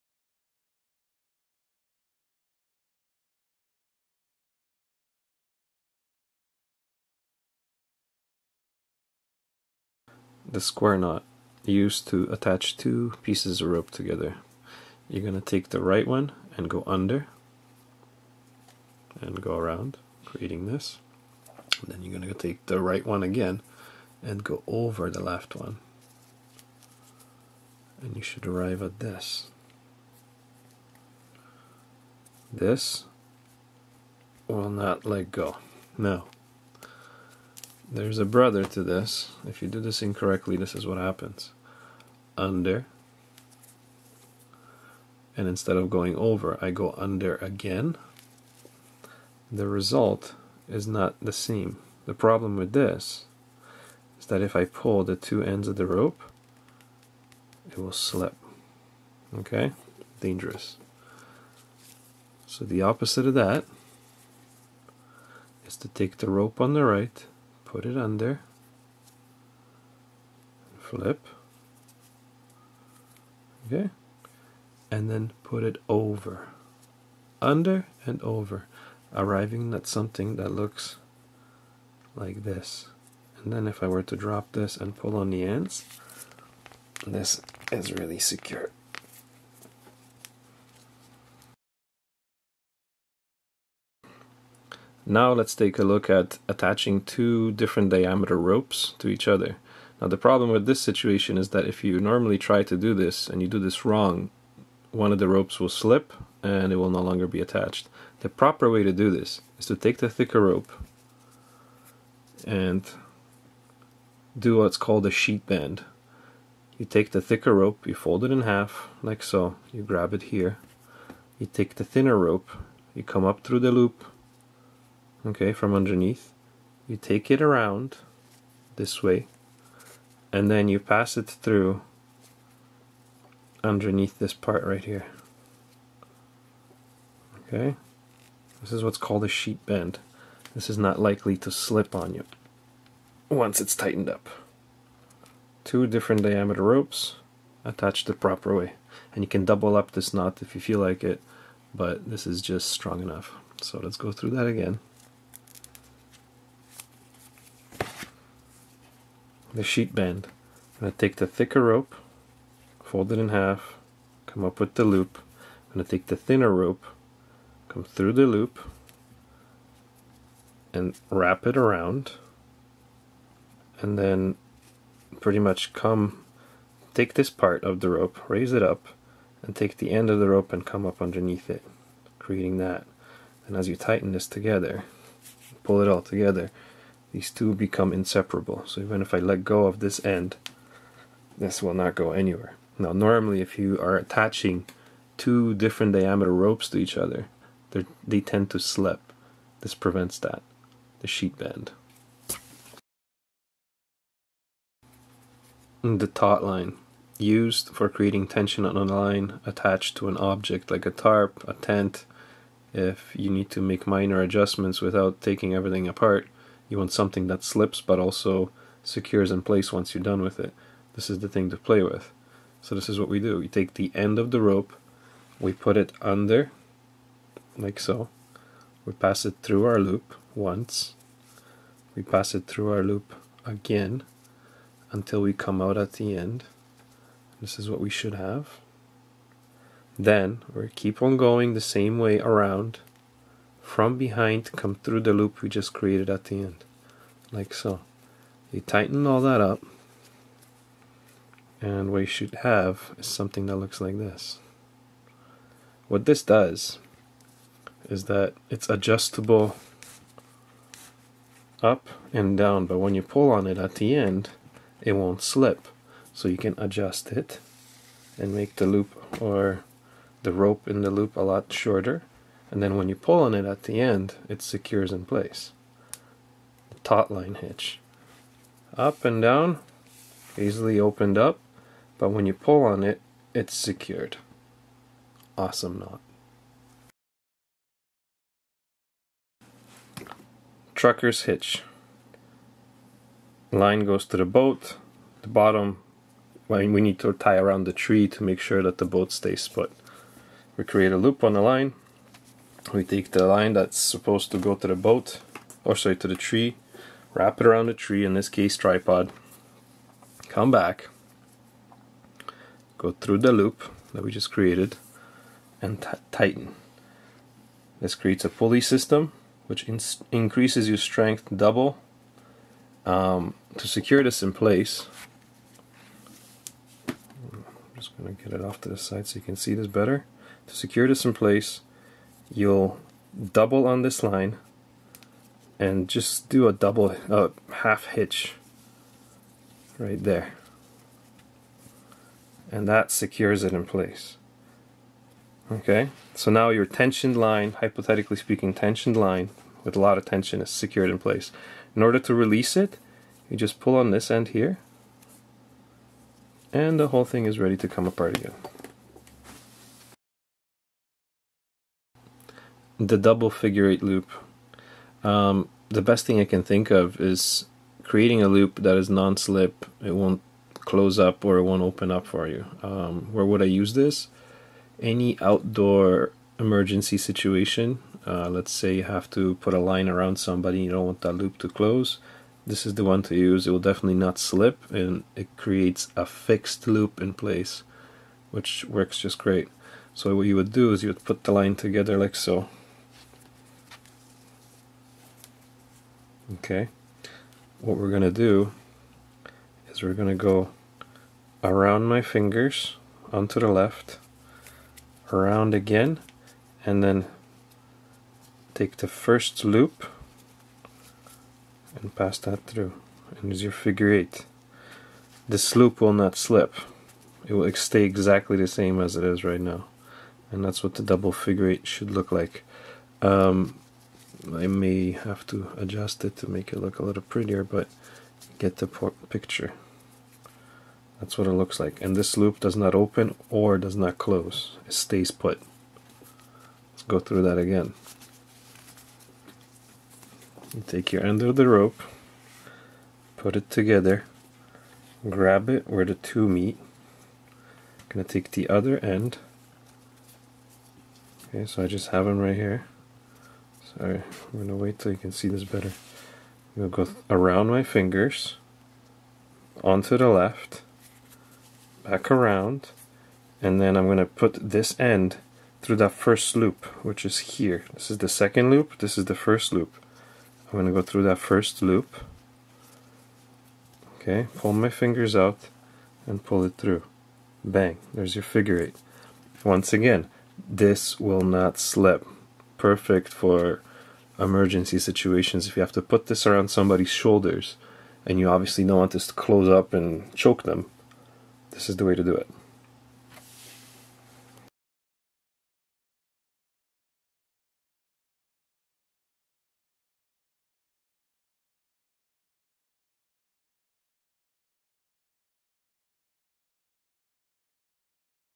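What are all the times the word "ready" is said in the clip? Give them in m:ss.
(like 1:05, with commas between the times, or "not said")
5:57.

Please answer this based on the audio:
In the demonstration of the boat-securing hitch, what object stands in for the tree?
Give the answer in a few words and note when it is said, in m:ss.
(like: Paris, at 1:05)
tripod, at 5:08.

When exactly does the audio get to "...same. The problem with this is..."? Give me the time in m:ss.
0:51.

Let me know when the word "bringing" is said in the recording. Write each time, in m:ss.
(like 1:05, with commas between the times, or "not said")
not said.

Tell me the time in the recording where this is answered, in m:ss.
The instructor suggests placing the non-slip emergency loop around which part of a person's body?
8:06.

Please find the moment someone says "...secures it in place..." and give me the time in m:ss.
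5:42.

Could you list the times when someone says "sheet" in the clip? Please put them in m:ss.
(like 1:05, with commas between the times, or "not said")
1:55, 2:19, 2:39, 3:21.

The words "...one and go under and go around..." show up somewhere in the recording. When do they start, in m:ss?
0:16.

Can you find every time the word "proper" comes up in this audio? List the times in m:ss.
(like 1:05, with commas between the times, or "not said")
1:48, 2:28.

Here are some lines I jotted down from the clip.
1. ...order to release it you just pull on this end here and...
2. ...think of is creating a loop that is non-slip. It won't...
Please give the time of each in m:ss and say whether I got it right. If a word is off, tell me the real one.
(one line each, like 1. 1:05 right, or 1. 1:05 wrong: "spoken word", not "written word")
1. 5:51 right
2. 6:06 right.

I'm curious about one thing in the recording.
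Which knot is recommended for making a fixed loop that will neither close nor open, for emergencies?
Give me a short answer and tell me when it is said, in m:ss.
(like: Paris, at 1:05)
double figure eight loop, at 6:02.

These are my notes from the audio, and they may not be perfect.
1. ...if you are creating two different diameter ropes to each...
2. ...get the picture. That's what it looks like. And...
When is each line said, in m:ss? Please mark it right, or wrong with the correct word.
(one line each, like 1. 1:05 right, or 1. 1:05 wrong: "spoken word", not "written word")
1. 3:13 wrong: "attaching", not "creating"
2. 7:08 right.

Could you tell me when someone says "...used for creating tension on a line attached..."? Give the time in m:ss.
3:27.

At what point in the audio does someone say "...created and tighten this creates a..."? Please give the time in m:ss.
5:14.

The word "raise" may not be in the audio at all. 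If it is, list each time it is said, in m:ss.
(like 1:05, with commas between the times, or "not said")
2:58.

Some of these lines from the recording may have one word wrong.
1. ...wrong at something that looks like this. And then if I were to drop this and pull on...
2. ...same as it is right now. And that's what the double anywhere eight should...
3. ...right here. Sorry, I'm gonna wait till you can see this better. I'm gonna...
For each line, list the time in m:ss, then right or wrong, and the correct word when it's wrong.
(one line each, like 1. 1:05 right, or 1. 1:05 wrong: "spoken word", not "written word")
1. 1:19 wrong: "arriving", not "wrong"
2. 6:58 wrong: "figure", not "anywhere"
3. 7:32 right.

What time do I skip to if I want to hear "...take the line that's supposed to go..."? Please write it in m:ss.
5:02.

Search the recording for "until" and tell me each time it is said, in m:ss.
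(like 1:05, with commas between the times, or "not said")
3:54.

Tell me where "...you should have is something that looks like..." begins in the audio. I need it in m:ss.
4:11.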